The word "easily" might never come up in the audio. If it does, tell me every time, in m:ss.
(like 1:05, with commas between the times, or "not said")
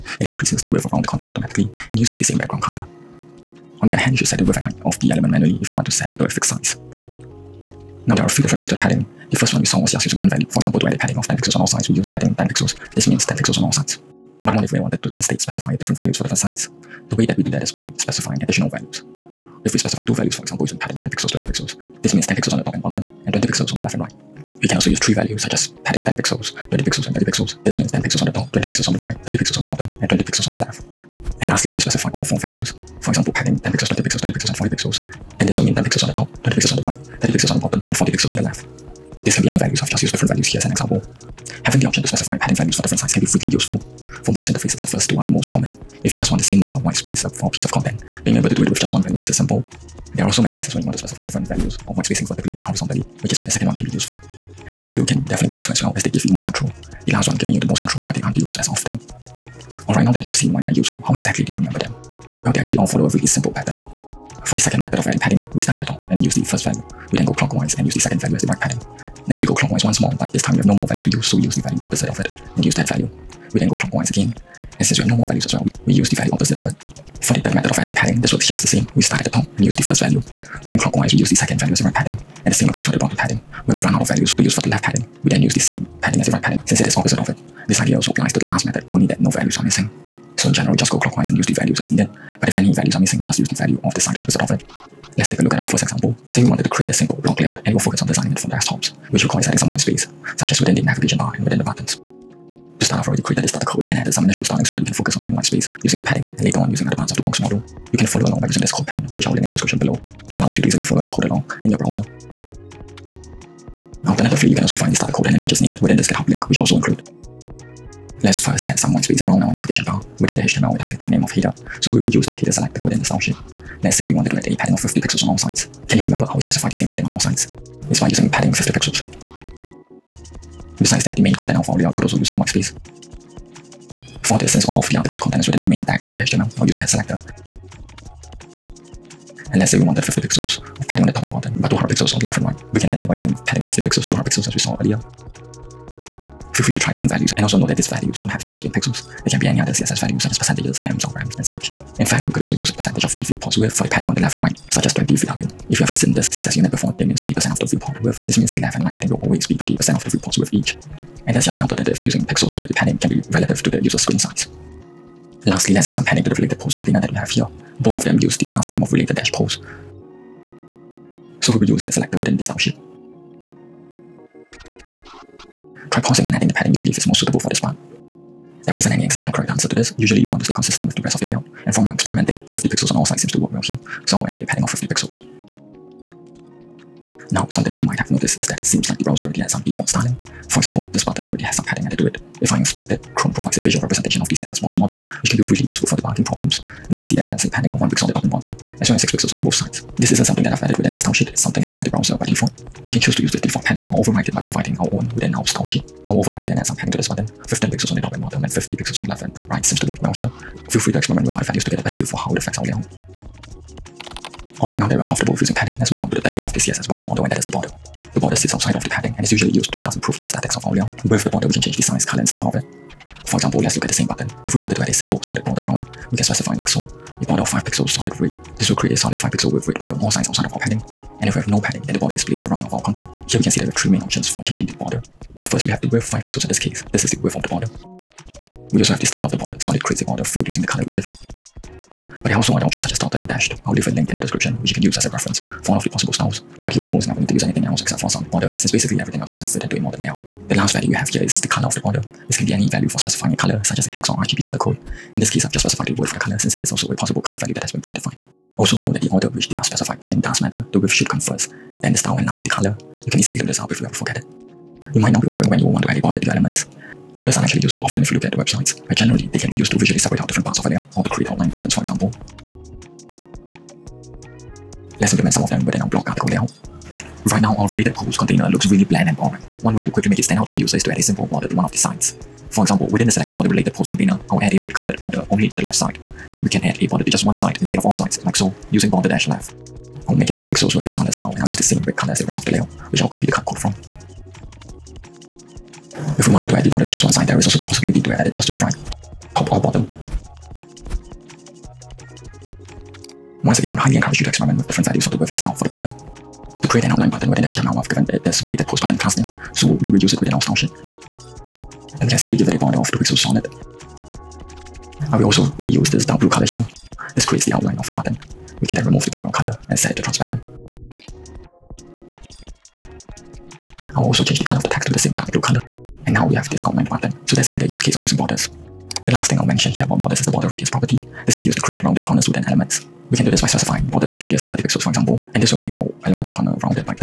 1:50, 4:23.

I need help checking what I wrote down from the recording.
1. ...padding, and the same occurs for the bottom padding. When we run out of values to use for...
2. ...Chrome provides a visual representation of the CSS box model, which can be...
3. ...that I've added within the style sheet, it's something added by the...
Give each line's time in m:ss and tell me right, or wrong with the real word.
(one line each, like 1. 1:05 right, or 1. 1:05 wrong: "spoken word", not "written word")
1. 1:21 right
2. 3:13 right
3. 3:20 right.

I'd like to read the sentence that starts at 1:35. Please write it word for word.
Let's take a look at our first example.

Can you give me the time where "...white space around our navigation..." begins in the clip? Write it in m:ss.
1:58.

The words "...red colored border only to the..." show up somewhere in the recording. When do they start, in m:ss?
4:44.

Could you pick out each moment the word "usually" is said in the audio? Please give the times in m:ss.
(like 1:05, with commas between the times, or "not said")
2:59, 3:39.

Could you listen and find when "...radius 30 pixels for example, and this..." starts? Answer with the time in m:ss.
5:34.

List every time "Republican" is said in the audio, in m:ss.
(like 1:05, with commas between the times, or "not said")
not said.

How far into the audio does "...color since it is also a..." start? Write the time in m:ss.
4:16.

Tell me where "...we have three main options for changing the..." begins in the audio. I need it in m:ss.
3:53.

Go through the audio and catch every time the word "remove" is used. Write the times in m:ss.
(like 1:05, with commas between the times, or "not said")
5:18.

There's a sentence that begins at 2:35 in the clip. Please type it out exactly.
If you haven't seen this CSS unit before, it means 20% of the viewport width.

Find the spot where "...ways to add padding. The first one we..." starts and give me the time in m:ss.
0:08.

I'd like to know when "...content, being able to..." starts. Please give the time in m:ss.
0:47.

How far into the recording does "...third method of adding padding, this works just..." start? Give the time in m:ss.
1:17.